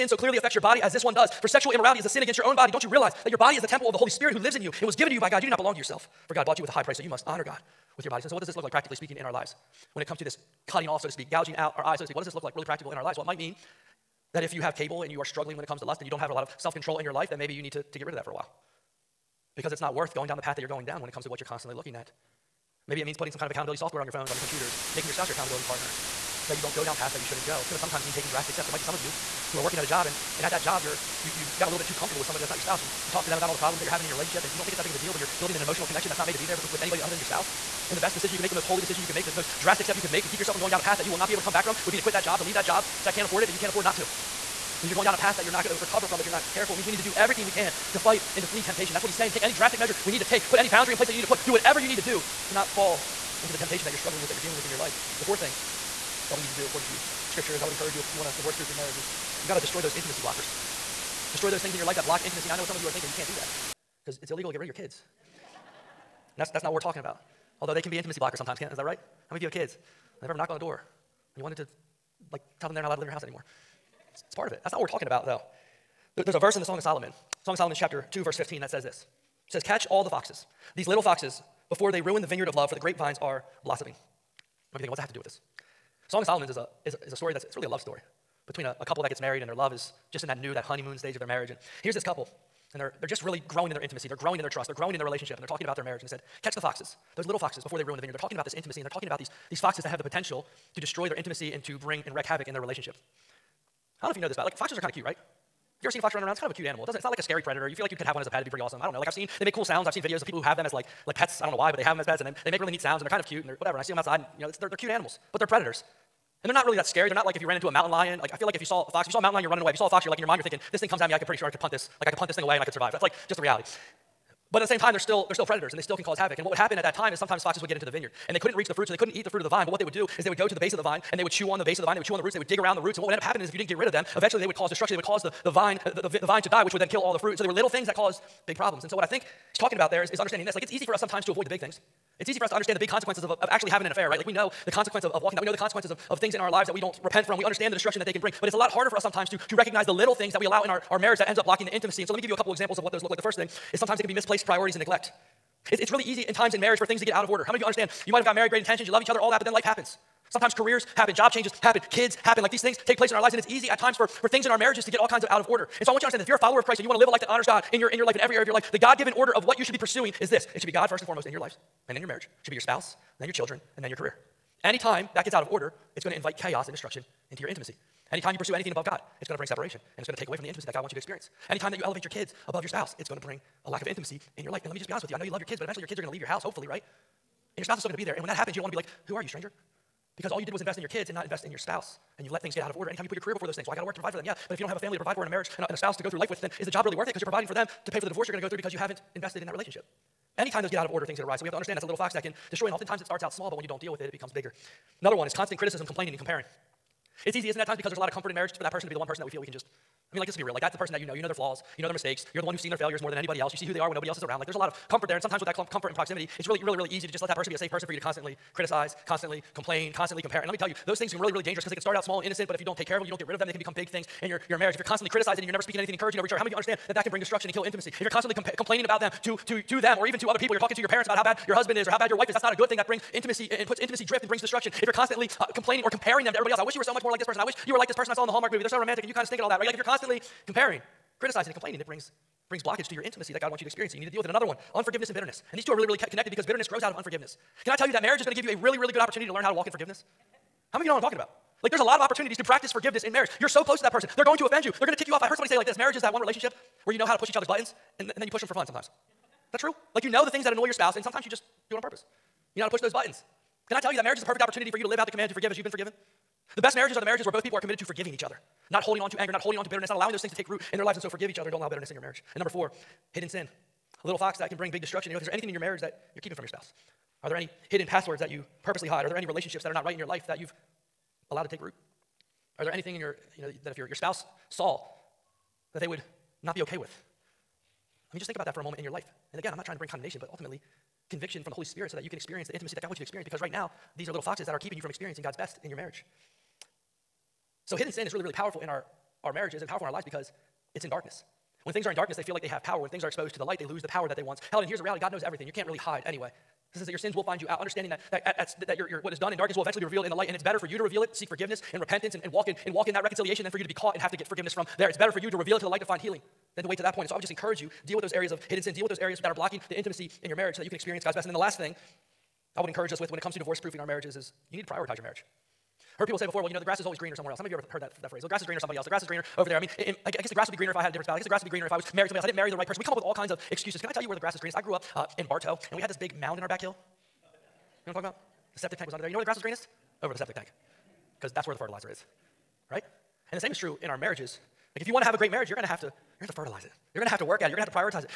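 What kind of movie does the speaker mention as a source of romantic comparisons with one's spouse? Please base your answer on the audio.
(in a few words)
Hallmark movie.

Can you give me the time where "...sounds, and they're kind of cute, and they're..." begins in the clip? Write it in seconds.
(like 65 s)
112 s.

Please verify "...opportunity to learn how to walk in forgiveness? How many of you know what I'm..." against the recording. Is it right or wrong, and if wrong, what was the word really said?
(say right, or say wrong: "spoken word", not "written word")
right.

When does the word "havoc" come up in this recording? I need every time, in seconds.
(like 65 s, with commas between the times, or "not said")
102 s, 126 s.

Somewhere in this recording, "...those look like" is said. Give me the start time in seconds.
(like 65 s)
152 s.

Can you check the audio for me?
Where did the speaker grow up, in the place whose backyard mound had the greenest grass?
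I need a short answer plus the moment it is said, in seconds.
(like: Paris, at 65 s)
Barto, at 335 s.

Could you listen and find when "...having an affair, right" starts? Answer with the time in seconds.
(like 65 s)
143 s.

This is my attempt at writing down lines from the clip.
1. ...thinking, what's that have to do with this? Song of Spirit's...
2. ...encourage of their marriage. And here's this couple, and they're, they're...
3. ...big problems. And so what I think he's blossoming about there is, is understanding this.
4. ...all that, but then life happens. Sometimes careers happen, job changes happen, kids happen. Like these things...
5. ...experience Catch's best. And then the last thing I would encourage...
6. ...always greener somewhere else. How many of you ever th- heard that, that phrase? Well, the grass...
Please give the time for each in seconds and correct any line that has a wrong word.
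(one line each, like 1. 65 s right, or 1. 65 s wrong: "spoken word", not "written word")
1. 84 s wrong: "Solomon", not "Spirit"
2. 90 s wrong: "stage", not "encourage"
3. 138 s wrong: "talking", not "blossoming"
4. 159 s right
5. 320 s wrong: "God", not "Catch"
6. 326 s right.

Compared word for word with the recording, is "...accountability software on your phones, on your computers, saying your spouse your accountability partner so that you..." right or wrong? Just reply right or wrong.
wrong.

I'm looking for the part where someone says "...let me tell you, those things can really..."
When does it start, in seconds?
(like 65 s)
220 s.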